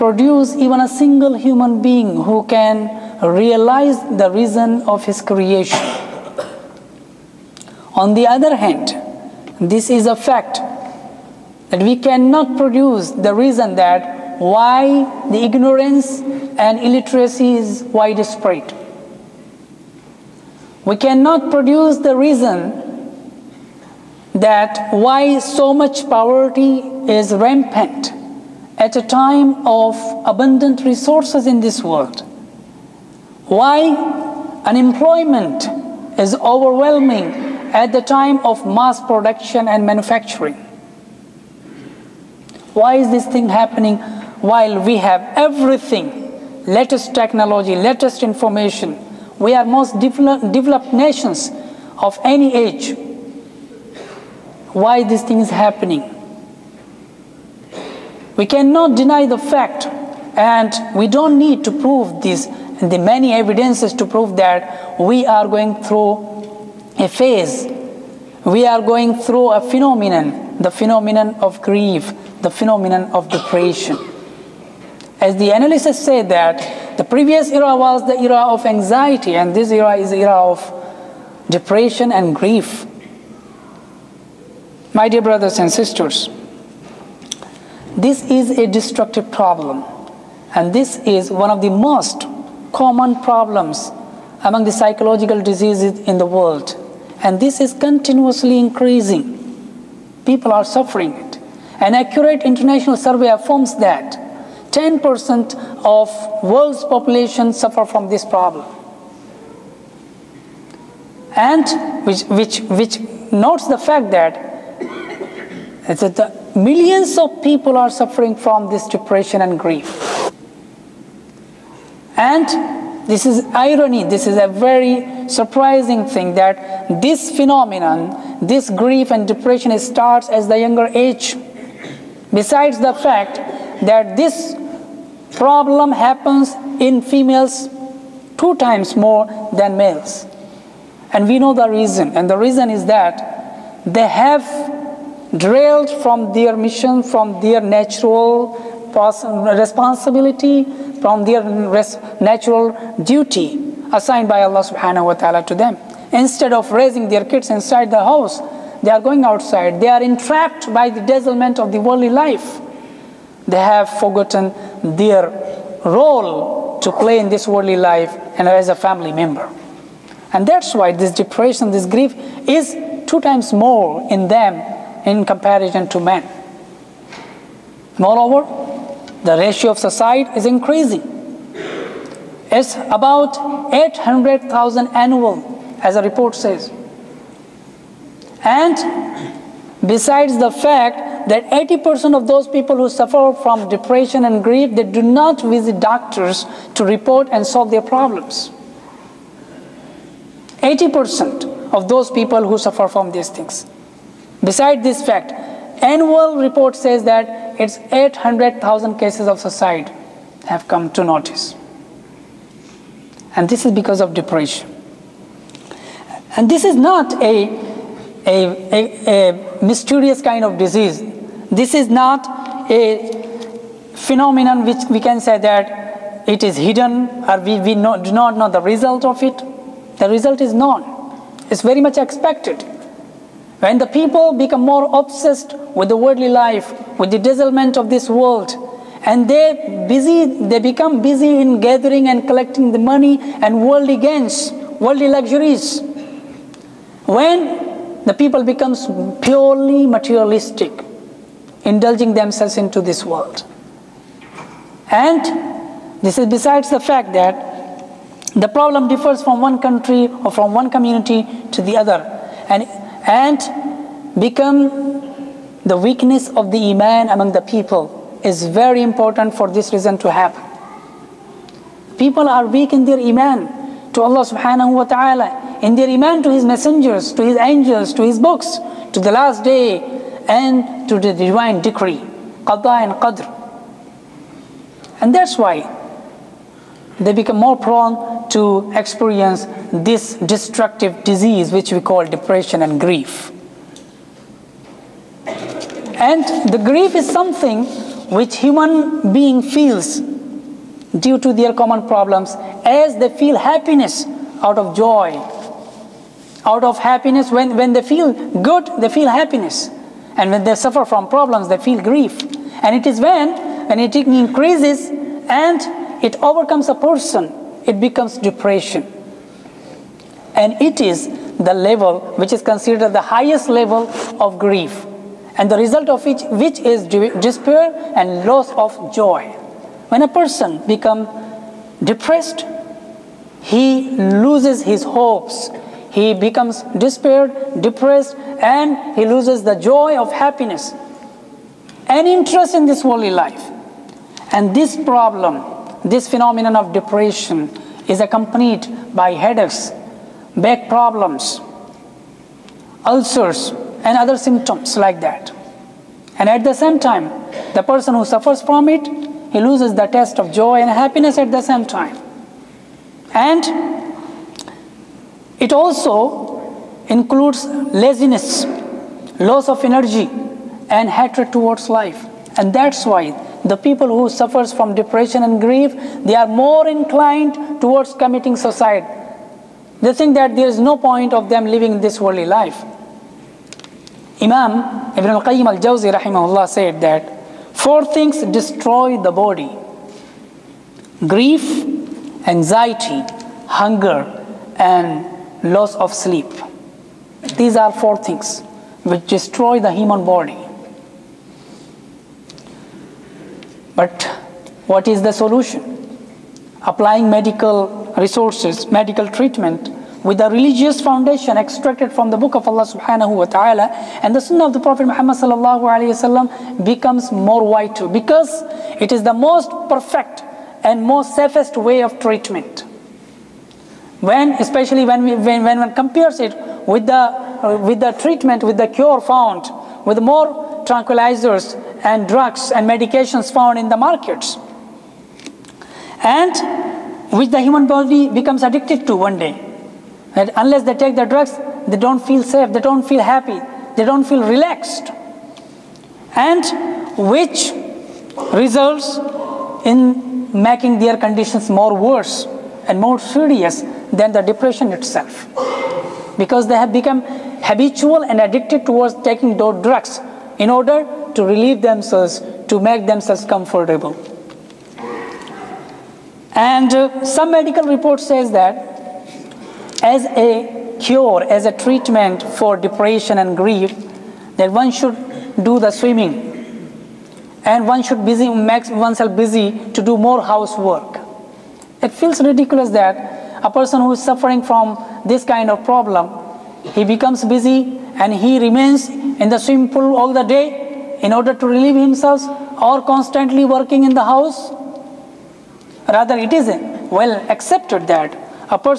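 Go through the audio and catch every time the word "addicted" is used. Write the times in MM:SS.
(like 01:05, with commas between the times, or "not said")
07:18, 07:38.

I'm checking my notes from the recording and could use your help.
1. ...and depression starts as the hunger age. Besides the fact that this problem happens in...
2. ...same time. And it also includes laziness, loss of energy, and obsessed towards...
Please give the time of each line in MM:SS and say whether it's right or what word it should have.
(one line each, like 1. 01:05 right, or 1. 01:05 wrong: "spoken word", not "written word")
1. 02:09 wrong: "younger", not "hunger"
2. 06:01 wrong: "hatred", not "obsessed".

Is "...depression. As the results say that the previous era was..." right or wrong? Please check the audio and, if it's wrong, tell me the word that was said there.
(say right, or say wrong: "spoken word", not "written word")
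wrong: "analysts", not "results".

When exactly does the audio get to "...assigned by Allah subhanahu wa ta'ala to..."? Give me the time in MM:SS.
02:33.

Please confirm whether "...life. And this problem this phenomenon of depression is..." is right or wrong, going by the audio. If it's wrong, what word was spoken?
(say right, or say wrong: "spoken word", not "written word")
right.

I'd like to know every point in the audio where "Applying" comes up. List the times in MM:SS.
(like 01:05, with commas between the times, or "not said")
06:46.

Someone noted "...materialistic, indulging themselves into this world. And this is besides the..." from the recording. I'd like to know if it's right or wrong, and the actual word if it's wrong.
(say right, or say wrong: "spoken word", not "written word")
right.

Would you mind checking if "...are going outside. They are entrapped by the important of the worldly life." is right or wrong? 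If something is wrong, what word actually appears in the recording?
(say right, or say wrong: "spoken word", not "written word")
wrong: "dazzlement", not "important".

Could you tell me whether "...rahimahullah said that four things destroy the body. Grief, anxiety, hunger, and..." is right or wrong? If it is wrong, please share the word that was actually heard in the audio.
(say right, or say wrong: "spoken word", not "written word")
right.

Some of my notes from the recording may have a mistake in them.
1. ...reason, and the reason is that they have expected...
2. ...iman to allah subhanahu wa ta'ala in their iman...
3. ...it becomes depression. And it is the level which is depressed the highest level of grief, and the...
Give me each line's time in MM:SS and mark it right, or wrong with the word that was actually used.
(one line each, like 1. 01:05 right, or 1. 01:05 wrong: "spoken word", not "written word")
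1. 02:21 wrong: "drilled", not "expected"
2. 04:32 right
3. 05:17 wrong: "considered", not "depressed".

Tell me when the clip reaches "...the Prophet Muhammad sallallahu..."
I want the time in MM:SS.
06:54.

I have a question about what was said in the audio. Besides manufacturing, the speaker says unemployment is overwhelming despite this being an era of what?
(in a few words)
mass production.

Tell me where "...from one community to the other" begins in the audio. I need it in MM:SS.
04:20.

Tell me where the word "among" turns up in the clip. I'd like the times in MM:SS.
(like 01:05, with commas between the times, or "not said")
01:34, 04:27.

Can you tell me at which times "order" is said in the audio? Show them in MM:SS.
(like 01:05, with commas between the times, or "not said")
07:40, 08:11.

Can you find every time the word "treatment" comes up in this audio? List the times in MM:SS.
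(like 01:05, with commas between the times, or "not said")
06:49, 07:01, 07:07, 07:51.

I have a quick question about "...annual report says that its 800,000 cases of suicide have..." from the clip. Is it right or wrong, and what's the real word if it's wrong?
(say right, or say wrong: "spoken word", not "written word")
right.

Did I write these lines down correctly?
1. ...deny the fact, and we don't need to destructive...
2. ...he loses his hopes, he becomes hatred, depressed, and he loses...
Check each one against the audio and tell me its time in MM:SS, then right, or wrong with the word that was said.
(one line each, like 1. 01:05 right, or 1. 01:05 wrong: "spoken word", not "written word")
1. 00:58 wrong: "prove", not "destructive"
2. 05:33 wrong: "despaired", not "hatred".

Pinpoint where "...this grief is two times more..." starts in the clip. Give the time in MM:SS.
02:51.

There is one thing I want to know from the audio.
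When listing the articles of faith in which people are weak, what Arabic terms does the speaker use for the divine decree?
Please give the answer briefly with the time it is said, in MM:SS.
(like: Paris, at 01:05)
qada and qadr, at 04:42.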